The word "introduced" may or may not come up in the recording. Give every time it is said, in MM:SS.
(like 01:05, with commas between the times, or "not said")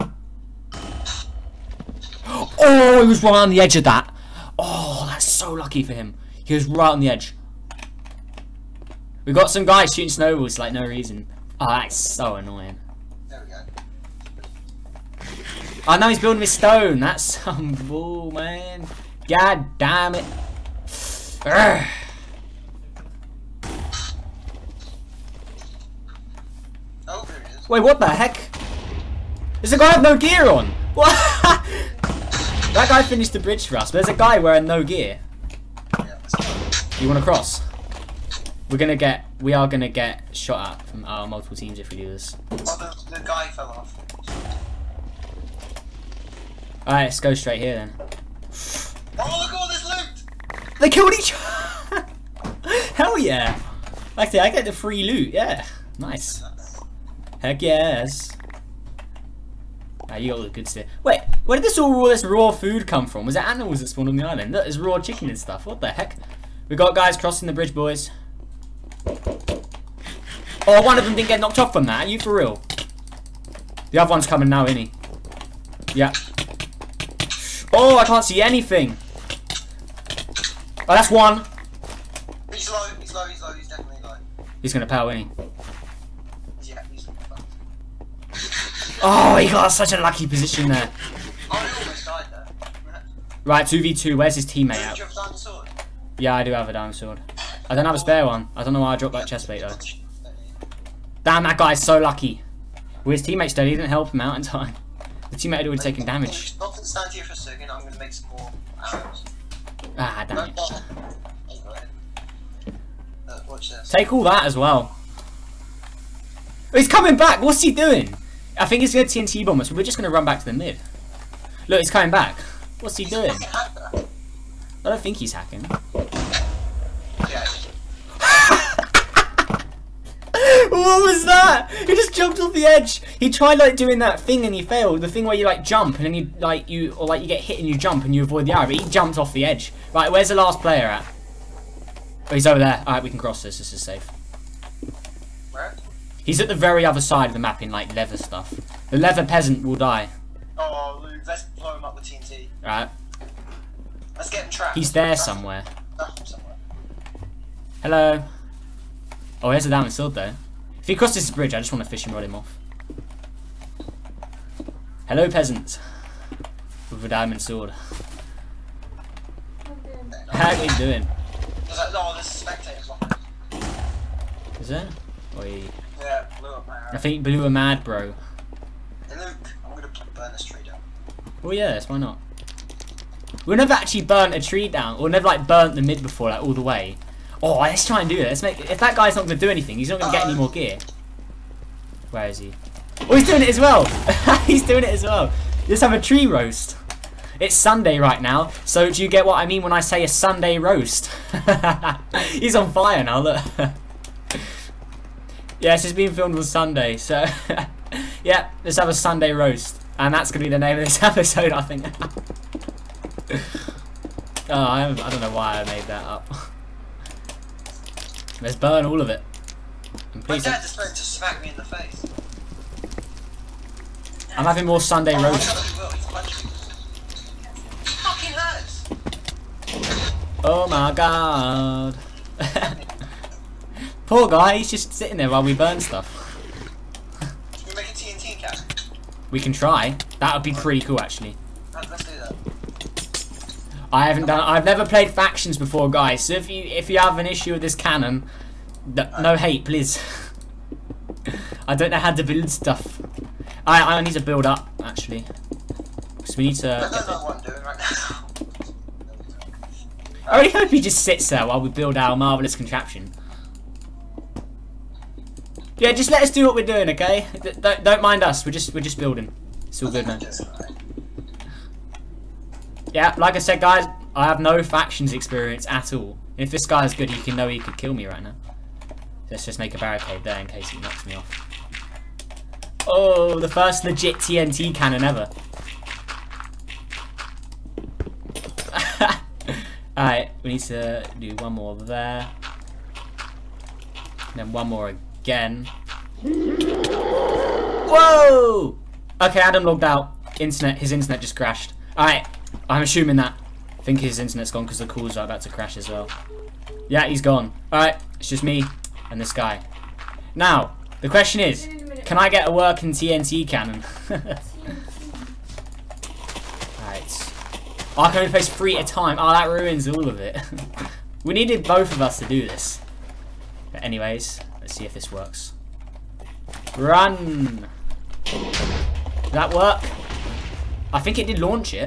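not said.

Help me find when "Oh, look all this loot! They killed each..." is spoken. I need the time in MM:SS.
00:47.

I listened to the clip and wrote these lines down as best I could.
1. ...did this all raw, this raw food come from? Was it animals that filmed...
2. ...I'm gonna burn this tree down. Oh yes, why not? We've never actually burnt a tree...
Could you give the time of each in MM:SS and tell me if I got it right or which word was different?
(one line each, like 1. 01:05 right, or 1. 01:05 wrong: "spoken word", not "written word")
1. 01:01 wrong: "spawned", not "filmed"
2. 02:59 right.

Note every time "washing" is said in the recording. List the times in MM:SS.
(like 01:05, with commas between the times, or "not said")
not said.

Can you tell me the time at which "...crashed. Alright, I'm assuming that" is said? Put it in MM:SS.
05:01.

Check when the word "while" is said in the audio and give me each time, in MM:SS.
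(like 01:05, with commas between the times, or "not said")
03:55, 04:21.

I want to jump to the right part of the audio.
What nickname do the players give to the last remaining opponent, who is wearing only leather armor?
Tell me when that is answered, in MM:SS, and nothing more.
02:28.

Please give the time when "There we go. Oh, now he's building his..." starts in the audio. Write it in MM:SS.
00:13.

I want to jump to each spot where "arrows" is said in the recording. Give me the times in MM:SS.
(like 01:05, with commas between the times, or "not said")
01:48, 02:18.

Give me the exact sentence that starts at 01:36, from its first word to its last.
Yeah, I do have a diamond sword.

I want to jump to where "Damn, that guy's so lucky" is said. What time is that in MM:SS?
01:41.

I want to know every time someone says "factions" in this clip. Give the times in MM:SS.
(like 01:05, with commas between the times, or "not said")
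04:05, 04:34.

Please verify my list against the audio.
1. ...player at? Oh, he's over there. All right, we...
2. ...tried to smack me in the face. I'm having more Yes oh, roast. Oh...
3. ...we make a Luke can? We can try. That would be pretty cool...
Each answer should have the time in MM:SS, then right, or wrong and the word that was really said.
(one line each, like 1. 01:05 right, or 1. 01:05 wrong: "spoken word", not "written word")
1. 02:20 right
2. 03:40 wrong: "Sunday", not "Yes"
3. 03:57 wrong: "TNT", not "Luke".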